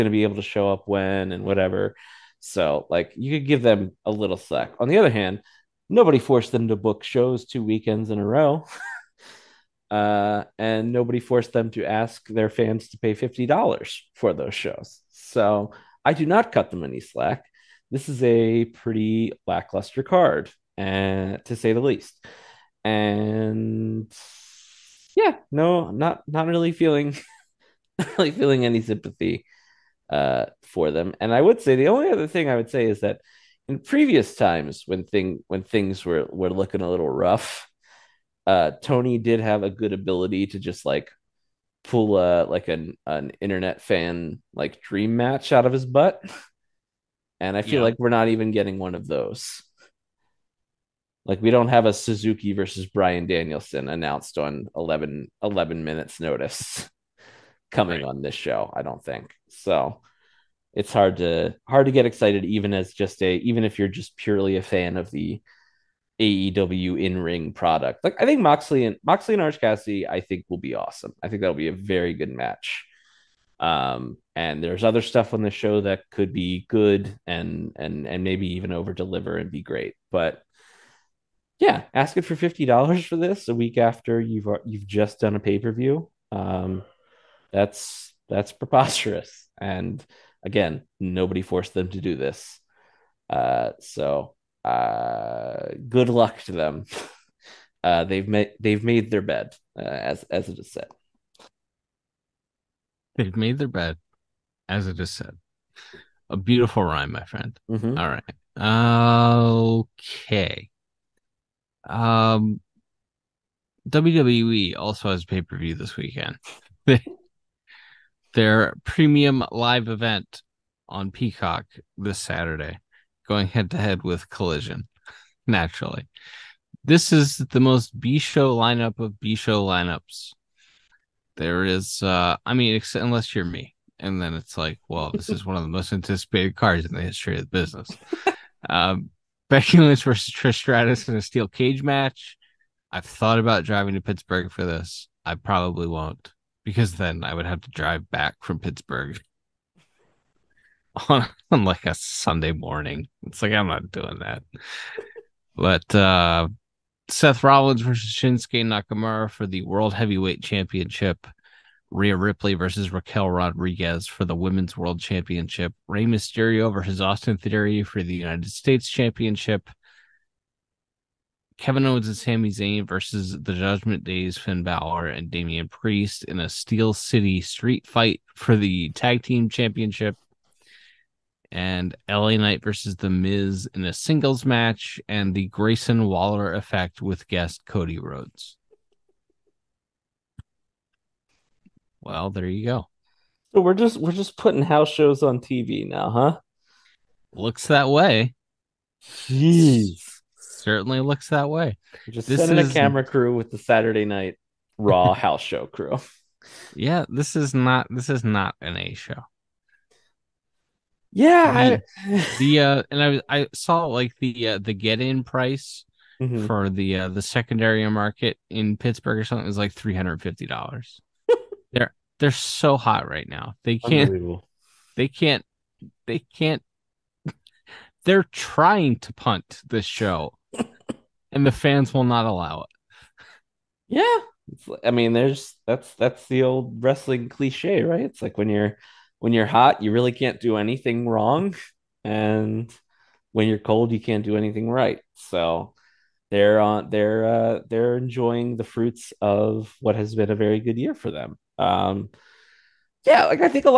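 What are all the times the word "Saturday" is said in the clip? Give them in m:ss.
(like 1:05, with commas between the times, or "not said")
2:02, 3:23.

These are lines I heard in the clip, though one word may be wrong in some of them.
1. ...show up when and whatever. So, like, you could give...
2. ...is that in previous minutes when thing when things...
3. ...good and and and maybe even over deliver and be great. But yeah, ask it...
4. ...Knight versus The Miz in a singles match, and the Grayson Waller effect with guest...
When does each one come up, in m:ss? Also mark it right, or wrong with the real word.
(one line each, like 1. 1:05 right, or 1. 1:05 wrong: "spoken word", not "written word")
1. 0:00 right
2. 0:32 wrong: "times", not "minutes"
3. 1:16 right
4. 3:02 right.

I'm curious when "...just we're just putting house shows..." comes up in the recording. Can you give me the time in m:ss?
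3:13.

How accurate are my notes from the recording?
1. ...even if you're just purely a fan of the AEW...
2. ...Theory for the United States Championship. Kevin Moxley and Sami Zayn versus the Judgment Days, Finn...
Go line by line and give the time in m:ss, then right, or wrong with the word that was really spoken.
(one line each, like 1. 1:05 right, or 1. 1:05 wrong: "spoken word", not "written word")
1. 1:03 right
2. 2:47 wrong: "Owens", not "Moxley".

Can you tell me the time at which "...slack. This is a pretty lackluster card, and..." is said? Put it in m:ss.
0:16.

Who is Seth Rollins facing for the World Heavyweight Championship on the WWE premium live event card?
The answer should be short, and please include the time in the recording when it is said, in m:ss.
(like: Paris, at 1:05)
Shinsuke Nakamura, at 2:38.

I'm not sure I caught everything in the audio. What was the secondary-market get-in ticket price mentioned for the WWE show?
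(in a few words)
$350.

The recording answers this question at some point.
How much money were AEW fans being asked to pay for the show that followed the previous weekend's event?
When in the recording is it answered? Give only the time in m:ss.
0:13.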